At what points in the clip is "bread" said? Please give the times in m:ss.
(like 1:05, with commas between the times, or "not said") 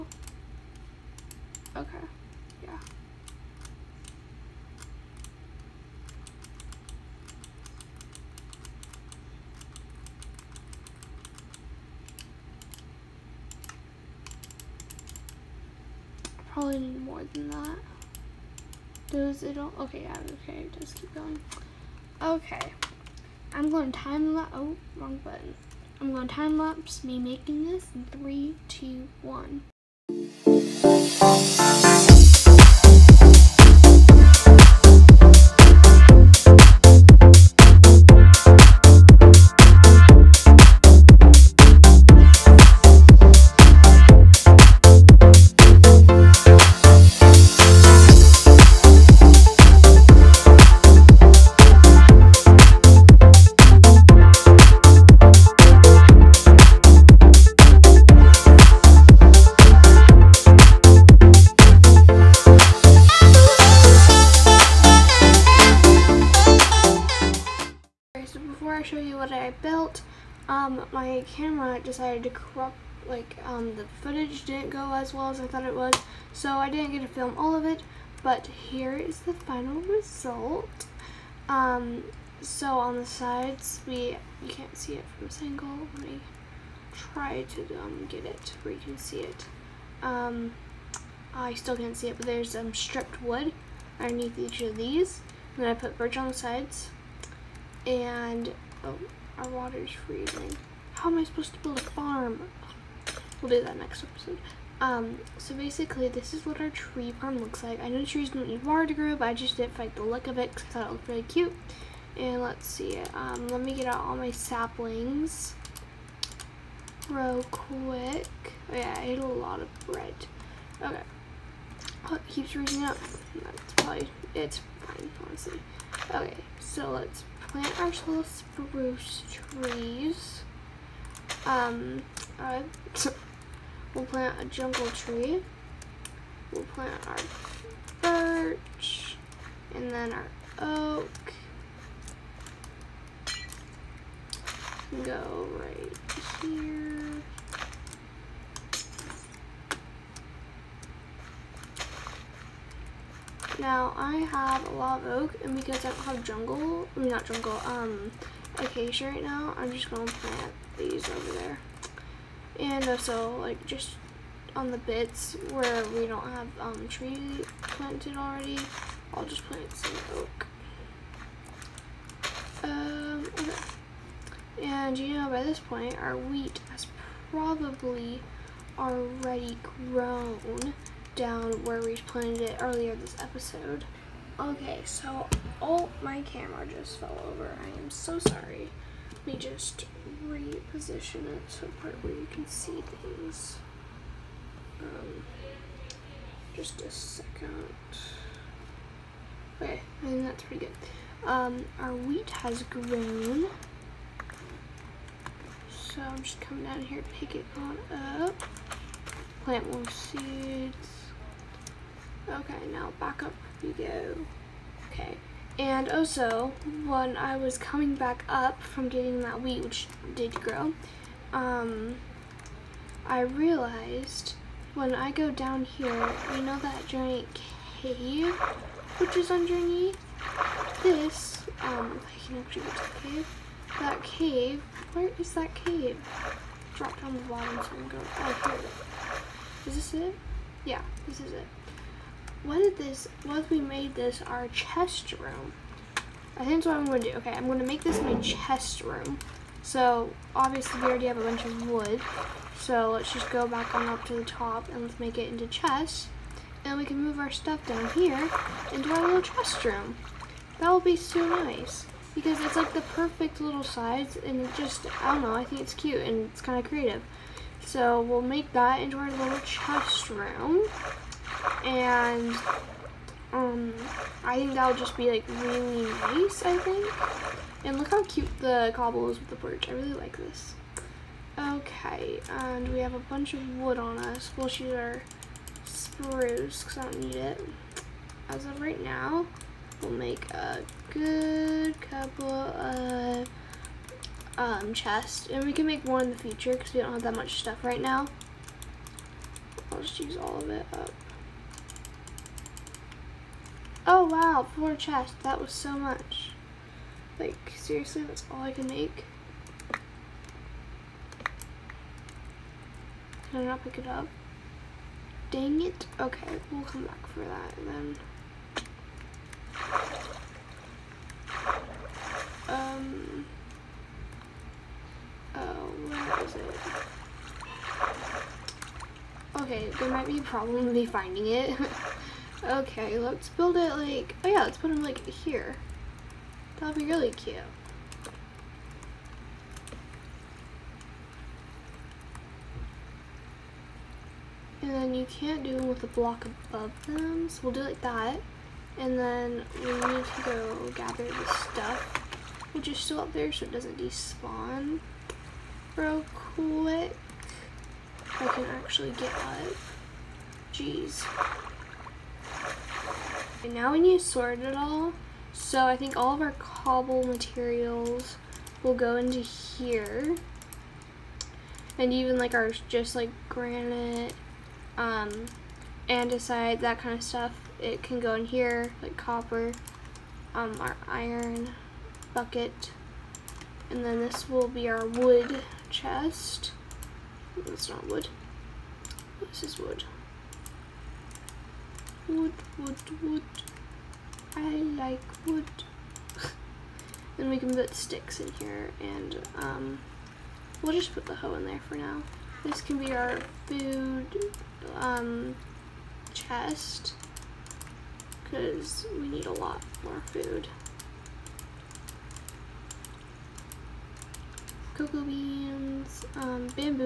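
1:59.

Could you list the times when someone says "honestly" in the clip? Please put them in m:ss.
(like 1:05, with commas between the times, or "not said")
2:05.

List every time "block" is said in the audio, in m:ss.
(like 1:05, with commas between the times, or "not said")
5:45.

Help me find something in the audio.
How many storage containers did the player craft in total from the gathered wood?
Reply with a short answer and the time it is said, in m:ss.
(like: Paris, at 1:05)
4, at 5:04.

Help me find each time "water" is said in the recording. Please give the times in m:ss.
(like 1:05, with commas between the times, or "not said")
1:39, 1:48.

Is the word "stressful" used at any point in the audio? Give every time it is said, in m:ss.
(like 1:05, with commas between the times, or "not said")
not said.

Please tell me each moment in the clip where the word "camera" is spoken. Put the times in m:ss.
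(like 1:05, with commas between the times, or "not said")
1:11, 3:06.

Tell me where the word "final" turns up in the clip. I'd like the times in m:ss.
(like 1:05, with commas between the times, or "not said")
1:19.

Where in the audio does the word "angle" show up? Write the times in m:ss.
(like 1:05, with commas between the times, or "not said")
1:25.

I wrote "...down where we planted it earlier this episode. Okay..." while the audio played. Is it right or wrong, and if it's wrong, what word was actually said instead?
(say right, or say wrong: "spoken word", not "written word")
right.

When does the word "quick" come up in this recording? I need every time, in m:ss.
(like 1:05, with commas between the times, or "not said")
1:57, 5:56.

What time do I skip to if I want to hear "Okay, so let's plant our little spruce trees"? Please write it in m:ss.
2:06.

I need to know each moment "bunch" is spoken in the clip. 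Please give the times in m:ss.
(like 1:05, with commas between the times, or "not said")
4:11, 4:42.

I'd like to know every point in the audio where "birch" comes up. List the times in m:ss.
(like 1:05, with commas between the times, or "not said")
1:35, 2:18, 4:39.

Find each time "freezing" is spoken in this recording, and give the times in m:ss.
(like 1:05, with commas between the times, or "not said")
1:39.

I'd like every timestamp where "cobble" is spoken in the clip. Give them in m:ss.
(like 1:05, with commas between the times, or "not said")
4:38, 6:06.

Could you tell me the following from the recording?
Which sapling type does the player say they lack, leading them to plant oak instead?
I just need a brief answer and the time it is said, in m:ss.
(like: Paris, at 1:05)
Acacia, at 2:38.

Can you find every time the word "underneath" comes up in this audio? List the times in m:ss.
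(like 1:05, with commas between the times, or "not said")
1:33, 3:49.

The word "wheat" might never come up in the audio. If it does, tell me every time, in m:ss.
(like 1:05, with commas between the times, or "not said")
2:56, 3:21, 3:39.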